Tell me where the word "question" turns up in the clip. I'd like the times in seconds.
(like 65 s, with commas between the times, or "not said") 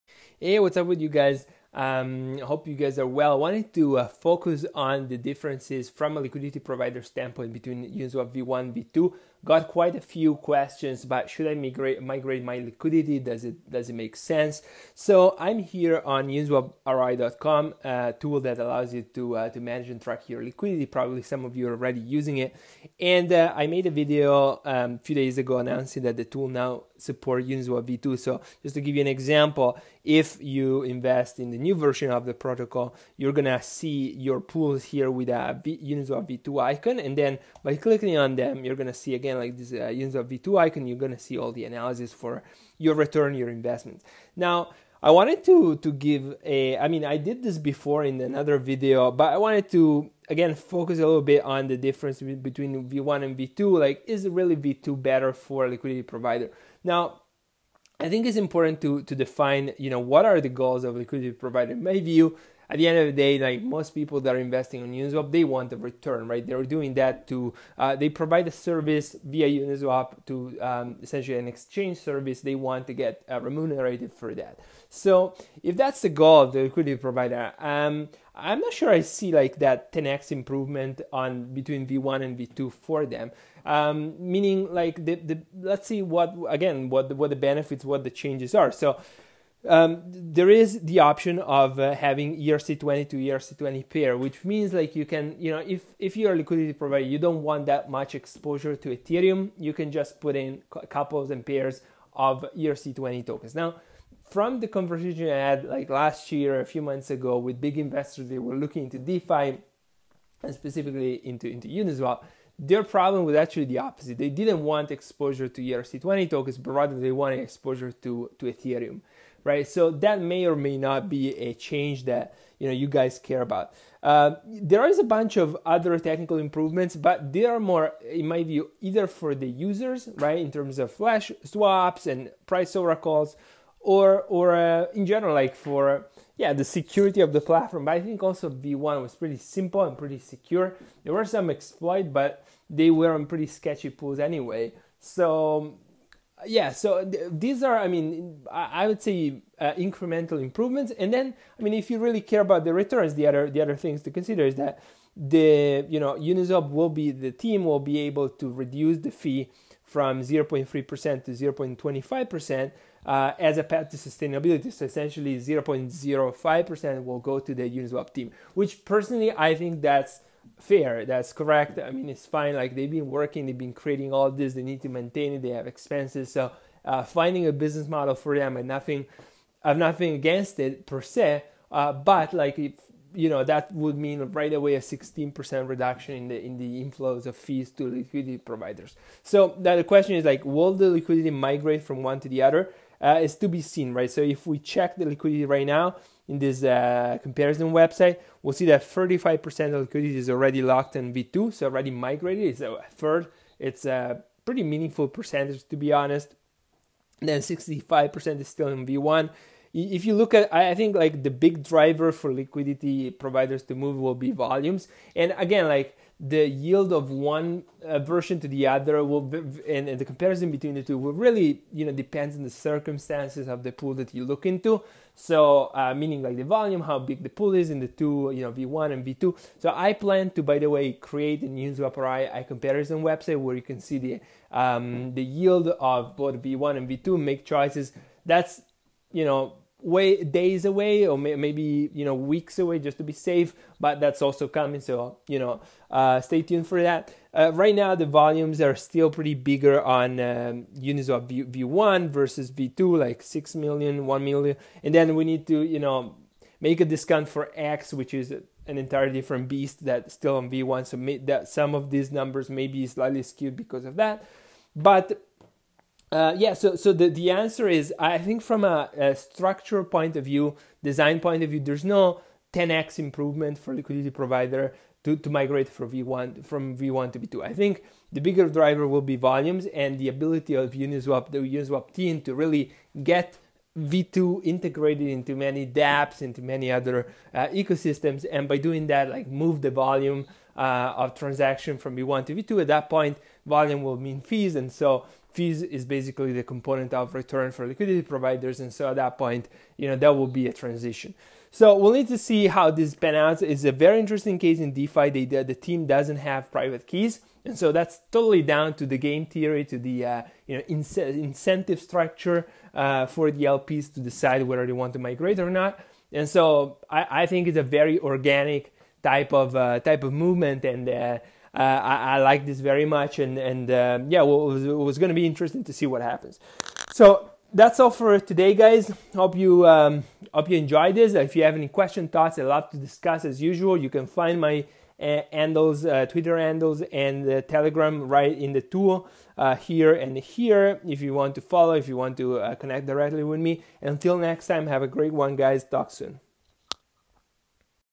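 10 s, 189 s, 331 s.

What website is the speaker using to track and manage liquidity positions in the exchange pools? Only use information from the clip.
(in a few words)
uniswaproi.com.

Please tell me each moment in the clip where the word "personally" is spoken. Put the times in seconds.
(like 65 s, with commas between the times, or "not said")
168 s.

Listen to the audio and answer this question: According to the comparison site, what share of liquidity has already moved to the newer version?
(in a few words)
35%.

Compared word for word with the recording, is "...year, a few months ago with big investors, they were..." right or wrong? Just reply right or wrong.
right.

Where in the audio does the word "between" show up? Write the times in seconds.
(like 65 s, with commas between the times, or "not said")
7 s, 52 s, 81 s, 220 s.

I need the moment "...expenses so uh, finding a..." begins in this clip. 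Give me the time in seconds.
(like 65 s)
175 s.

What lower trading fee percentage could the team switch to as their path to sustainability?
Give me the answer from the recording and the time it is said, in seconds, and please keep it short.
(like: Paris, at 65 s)
0.25%, at 161 s.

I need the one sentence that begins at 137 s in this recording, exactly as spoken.
But I think also V1 was pretty simple and pretty secure.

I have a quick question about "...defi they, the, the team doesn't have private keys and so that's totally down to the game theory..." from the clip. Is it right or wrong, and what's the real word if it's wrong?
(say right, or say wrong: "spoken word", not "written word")
right.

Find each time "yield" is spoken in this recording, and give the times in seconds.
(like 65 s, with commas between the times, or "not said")
216 s, 235 s.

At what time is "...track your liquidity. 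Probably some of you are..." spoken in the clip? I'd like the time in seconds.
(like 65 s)
20 s.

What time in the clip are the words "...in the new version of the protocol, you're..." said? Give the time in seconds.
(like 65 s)
31 s.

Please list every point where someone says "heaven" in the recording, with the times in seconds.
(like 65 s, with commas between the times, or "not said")
not said.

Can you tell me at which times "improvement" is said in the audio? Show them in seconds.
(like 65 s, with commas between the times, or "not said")
80 s, 126 s, 150 s, 272 s.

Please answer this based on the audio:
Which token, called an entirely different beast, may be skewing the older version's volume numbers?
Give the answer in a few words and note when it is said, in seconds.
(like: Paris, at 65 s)
HEX, at 257 s.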